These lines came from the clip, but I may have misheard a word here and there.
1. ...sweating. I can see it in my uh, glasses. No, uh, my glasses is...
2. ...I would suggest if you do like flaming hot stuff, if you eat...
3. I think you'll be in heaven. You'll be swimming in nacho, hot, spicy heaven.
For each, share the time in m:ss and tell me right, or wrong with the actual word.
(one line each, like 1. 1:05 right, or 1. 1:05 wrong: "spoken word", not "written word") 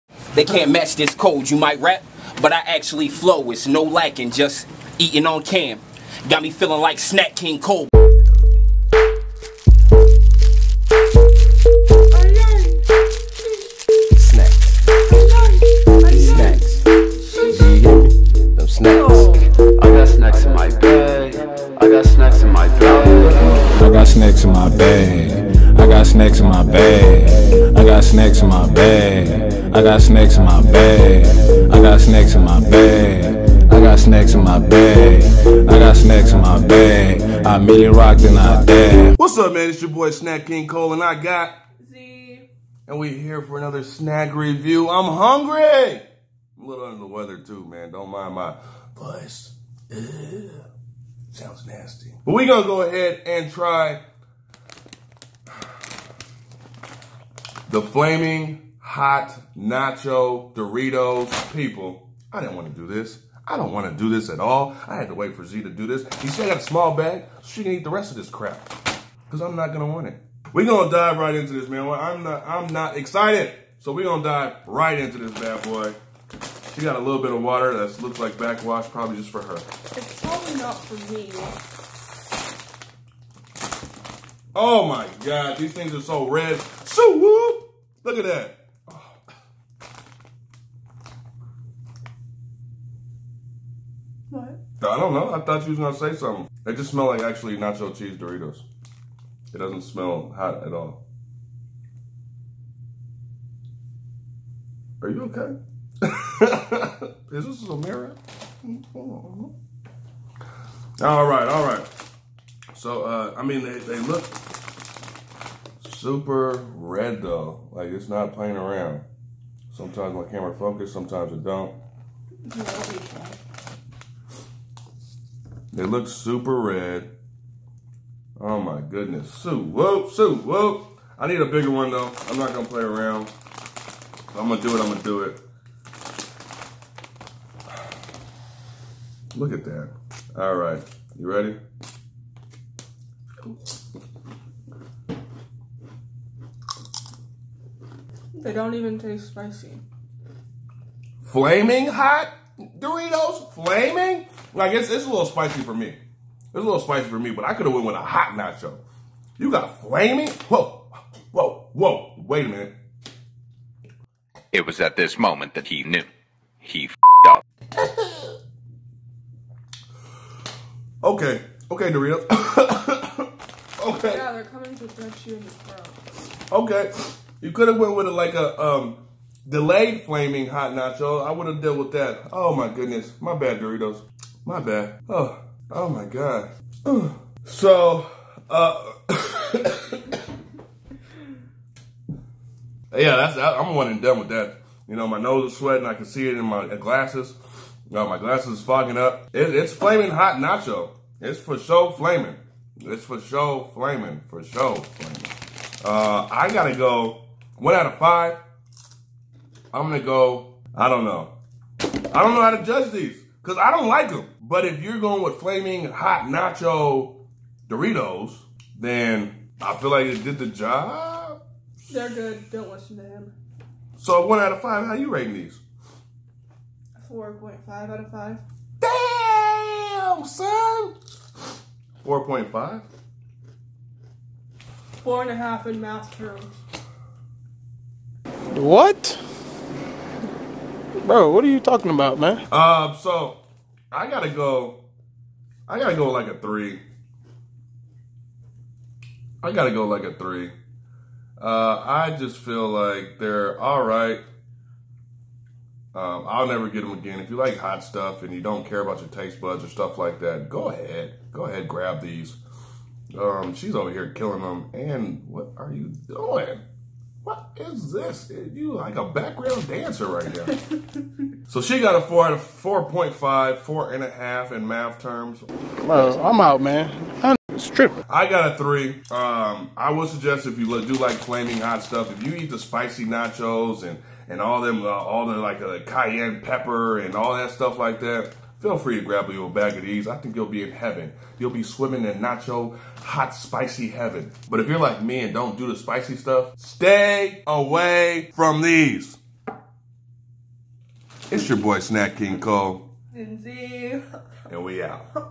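1. 3:15 right
2. 4:39 right
3. 4:50 right.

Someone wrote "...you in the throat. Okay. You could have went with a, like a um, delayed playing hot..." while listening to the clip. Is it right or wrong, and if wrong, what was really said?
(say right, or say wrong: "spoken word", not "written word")
wrong: "flaming", not "playing".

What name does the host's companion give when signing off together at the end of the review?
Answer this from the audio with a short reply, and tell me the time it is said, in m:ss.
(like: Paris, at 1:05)
Lindsay, at 5:03.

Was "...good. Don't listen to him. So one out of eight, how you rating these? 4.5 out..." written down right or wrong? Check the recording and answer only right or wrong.
wrong.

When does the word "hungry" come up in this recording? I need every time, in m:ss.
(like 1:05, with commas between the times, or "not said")
0:45.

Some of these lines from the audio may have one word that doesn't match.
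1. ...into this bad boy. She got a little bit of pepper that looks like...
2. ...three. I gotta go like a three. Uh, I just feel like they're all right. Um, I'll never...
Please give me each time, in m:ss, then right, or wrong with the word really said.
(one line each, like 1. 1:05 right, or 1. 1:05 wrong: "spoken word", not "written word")
1. 1:14 wrong: "water", not "pepper"
2. 4:06 right.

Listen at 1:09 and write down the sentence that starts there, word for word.
Because I'm not going to want it.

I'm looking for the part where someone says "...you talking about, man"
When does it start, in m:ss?
4:01.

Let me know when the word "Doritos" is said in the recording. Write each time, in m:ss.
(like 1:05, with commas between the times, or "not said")
1:00, 1:38, 2:32, 2:51, 3:03, 3:37.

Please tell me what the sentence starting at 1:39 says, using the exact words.
It doesn't smell hot at all.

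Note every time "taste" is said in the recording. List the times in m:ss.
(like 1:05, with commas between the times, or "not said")
2:28, 4:19.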